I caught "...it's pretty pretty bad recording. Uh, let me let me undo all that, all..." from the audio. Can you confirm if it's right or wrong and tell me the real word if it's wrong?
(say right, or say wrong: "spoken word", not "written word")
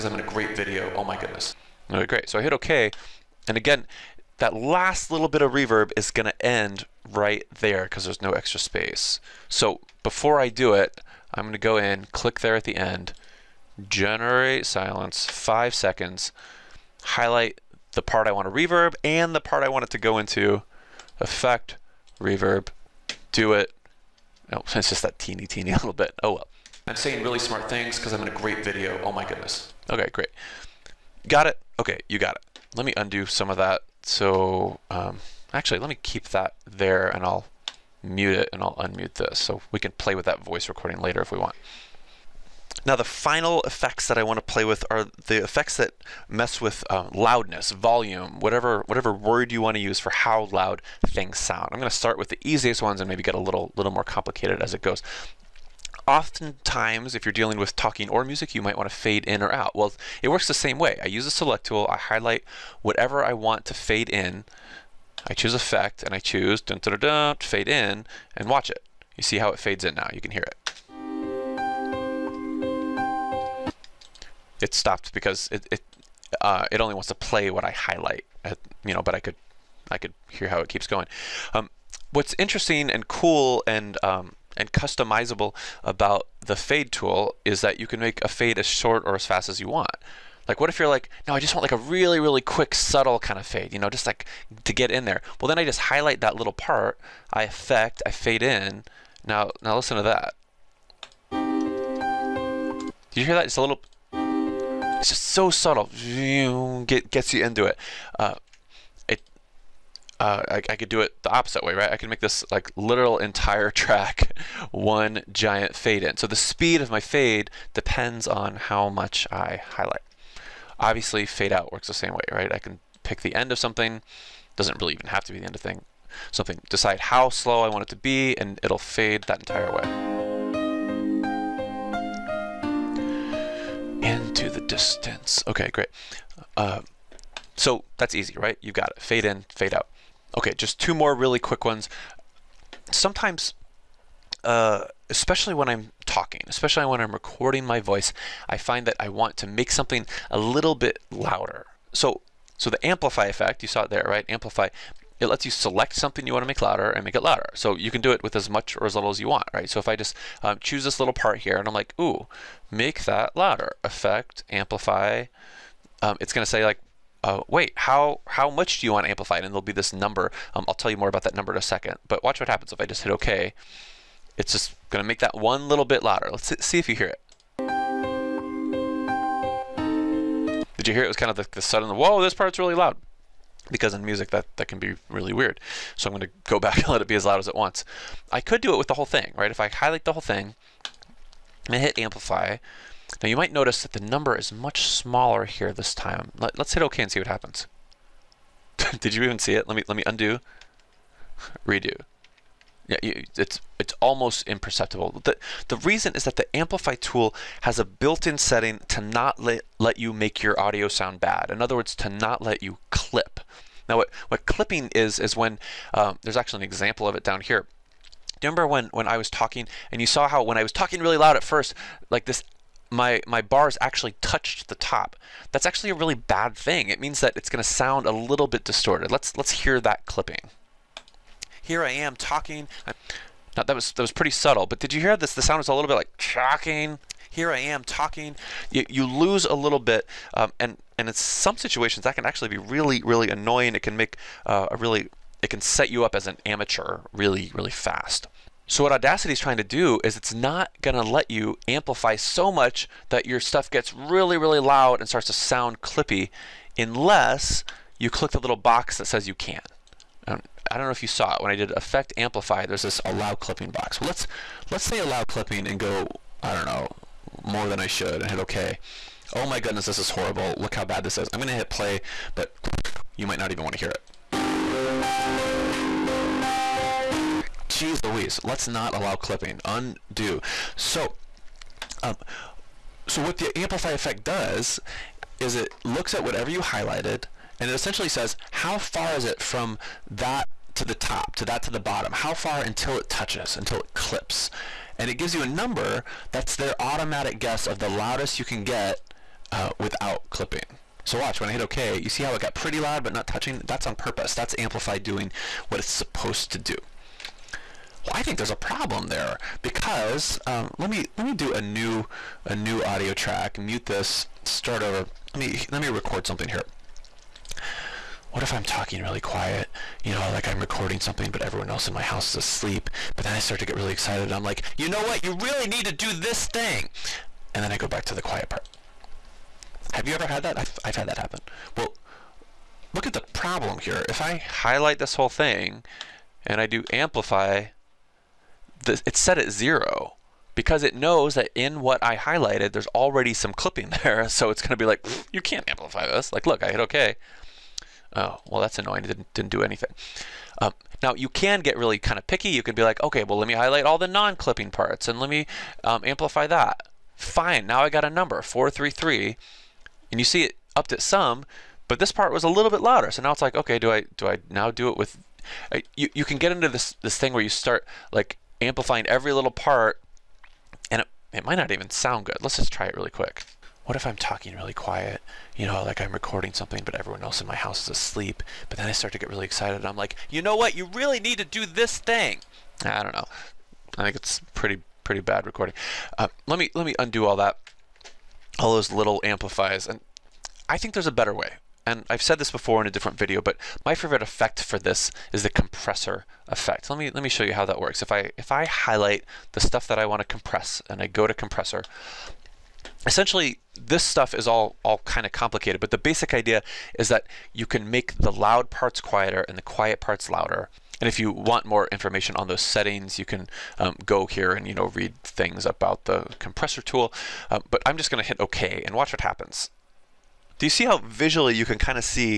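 right.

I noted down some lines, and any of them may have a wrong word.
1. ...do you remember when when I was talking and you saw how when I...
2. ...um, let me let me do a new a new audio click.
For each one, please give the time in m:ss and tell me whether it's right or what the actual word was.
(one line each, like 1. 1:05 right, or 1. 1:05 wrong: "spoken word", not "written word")
1. 3:38 right
2. 5:10 wrong: "track", not "click".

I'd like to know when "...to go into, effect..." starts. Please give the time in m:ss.
0:19.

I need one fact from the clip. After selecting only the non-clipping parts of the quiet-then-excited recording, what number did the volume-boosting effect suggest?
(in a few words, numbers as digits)
433.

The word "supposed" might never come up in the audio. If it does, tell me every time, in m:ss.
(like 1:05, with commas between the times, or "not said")
5:05.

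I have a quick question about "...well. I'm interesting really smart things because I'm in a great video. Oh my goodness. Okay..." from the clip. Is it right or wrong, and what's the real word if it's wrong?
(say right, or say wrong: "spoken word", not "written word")
wrong: "saying", not "interesting".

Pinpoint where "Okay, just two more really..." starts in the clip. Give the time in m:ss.
2:20.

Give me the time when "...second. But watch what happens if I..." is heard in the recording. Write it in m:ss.
2:51.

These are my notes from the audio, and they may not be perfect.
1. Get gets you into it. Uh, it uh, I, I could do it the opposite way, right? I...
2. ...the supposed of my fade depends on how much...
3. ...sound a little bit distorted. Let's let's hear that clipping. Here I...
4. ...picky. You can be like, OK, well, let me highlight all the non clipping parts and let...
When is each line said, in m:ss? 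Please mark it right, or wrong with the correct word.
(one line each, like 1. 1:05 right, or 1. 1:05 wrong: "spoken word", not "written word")
1. 1:46 right
2. 1:56 wrong: "speed", not "supposed"
3. 3:47 right
4. 5:52 right.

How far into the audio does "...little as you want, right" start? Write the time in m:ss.
2:38.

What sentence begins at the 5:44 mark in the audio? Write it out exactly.
So it's going to be like, you can't amplify this.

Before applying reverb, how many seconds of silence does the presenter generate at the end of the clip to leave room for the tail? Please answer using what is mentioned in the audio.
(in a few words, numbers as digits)
5 seconds.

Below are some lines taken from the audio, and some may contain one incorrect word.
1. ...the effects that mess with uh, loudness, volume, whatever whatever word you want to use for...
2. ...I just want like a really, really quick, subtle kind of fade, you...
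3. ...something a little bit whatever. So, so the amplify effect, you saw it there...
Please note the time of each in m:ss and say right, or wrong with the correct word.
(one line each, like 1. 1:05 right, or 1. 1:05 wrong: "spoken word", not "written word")
1. 0:45 right
2. 1:31 right
3. 2:29 wrong: "louder", not "whatever".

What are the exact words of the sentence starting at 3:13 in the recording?
Now you might notice that the number is much smaller here this time.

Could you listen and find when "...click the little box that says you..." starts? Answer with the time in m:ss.
4:18.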